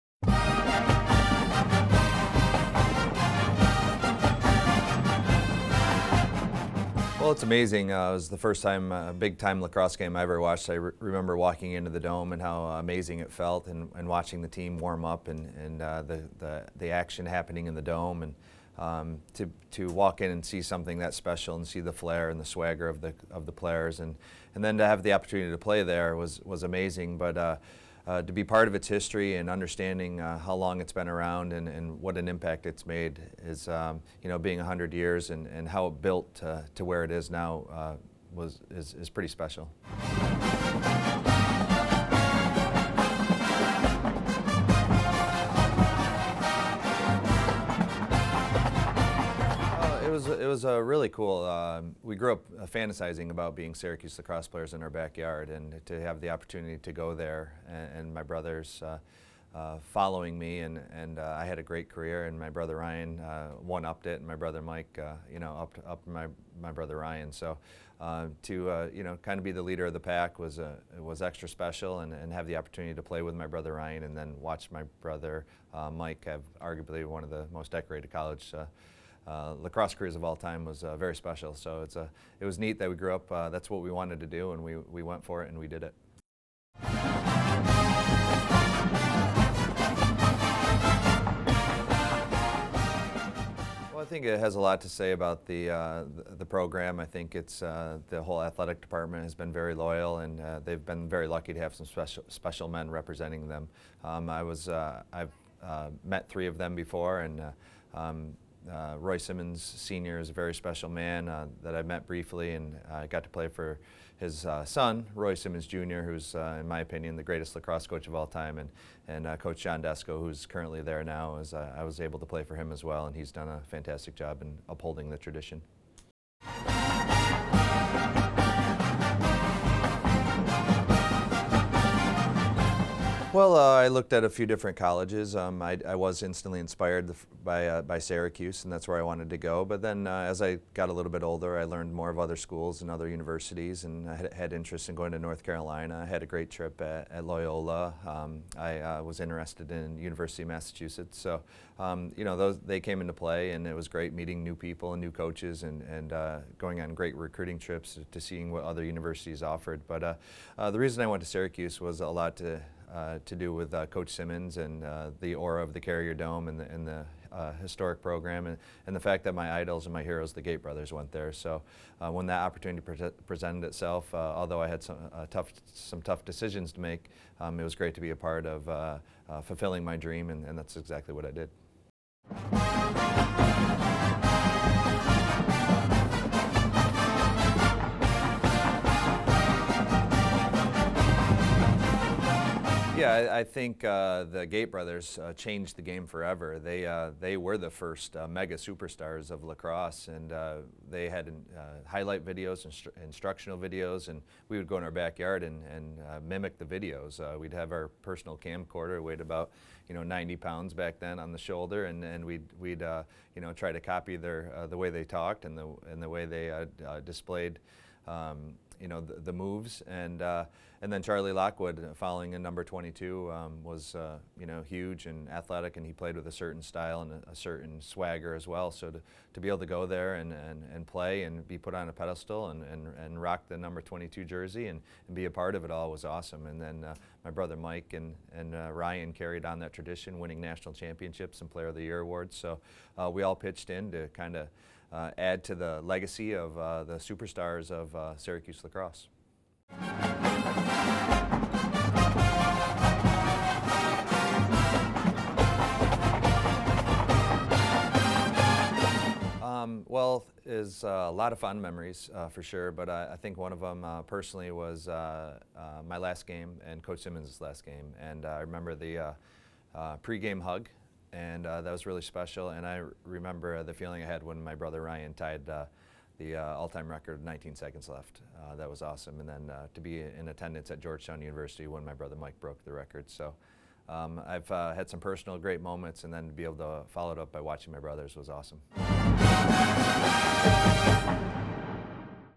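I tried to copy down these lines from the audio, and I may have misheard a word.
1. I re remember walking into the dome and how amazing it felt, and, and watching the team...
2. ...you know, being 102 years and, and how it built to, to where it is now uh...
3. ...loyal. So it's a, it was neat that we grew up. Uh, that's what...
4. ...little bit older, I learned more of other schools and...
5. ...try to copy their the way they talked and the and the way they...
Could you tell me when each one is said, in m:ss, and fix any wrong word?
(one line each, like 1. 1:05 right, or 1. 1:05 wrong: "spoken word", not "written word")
1. 0:10 right
2. 0:34 wrong: "100", not "102"
3. 1:21 wrong: "special", not "loyal"
4. 2:20 right
5. 3:33 right.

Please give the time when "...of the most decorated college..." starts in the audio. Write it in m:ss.
1:17.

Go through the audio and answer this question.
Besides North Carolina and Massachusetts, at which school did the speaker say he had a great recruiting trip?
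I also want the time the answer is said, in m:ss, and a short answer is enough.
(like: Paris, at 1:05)
Loyola, at 2:27.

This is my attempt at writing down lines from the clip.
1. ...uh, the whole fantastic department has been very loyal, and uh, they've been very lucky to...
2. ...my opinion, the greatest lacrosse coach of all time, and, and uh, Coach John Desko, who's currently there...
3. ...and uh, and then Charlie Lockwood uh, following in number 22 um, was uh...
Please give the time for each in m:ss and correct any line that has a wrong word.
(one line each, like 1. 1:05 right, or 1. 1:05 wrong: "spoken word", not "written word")
1. 1:37 wrong: "athletic", not "fantastic"
2. 1:56 right
3. 3:39 right.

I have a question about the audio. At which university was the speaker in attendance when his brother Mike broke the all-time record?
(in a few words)
Georgetown University.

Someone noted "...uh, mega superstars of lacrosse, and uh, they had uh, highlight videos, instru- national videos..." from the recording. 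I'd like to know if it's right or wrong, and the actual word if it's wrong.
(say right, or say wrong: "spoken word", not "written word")
wrong: "instructional", not "national".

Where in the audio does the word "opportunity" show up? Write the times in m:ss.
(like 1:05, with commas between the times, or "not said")
0:25, 0:56, 1:12, 2:52.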